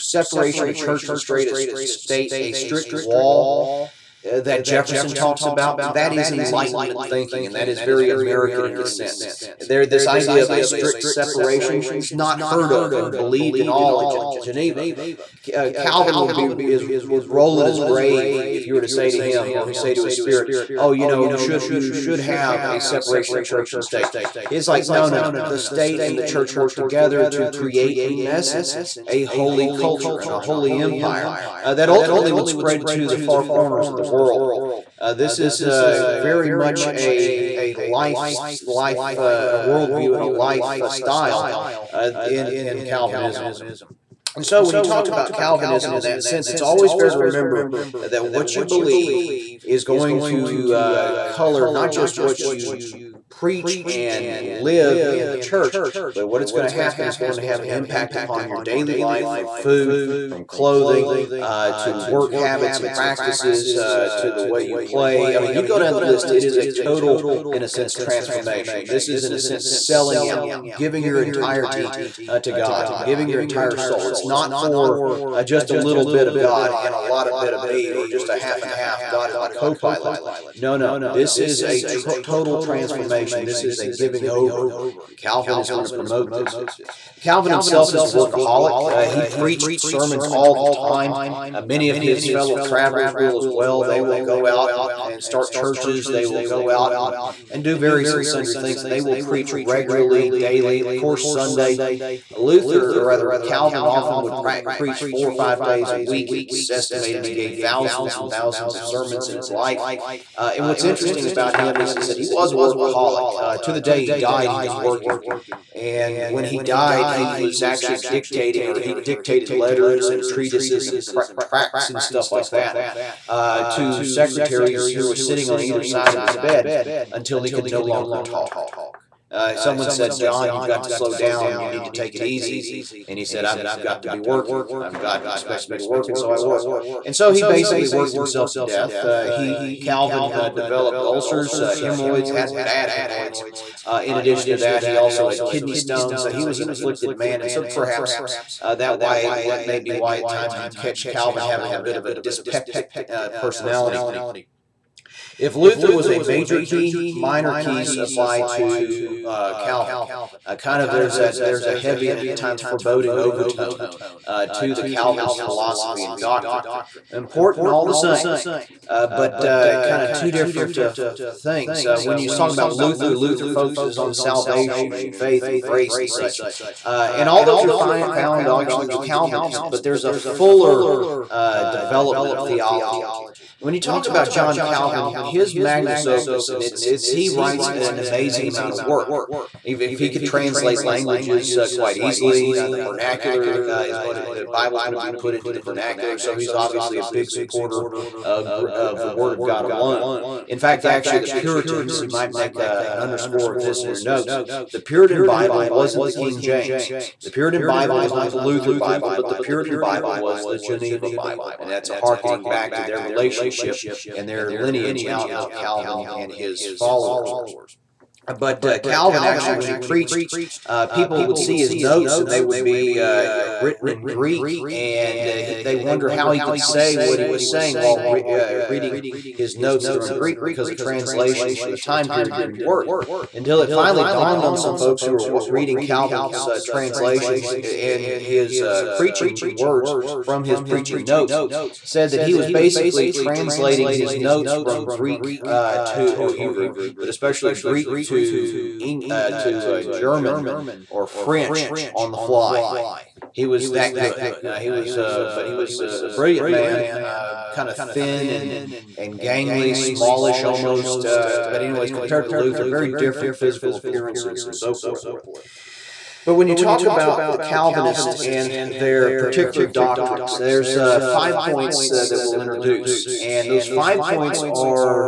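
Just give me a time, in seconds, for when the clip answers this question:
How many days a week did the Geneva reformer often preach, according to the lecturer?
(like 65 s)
105 s.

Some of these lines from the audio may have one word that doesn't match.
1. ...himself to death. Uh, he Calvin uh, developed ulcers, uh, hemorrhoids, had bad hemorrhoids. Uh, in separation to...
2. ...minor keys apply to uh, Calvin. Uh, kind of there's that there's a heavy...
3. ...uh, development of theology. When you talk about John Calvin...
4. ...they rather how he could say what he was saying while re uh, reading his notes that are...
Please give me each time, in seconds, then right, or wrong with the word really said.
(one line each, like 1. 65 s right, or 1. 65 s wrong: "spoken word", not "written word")
1. 138 s wrong: "addition", not "separation"
2. 157 s right
3. 181 s right
4. 225 s wrong: "wonder", not "rather".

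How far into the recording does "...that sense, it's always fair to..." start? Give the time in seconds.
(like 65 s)
46 s.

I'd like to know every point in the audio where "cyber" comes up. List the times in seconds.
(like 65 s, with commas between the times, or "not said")
not said.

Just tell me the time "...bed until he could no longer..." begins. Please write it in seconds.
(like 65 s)
126 s.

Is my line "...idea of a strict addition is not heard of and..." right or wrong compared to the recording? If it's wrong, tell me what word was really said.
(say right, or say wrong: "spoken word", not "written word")
wrong: "separation", not "addition".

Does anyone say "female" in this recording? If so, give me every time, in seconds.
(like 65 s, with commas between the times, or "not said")
not said.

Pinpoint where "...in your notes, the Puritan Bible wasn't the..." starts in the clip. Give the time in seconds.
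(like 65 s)
203 s.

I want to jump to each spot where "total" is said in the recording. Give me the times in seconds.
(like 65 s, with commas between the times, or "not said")
66 s, 82 s.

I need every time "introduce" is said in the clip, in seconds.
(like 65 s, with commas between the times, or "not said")
272 s.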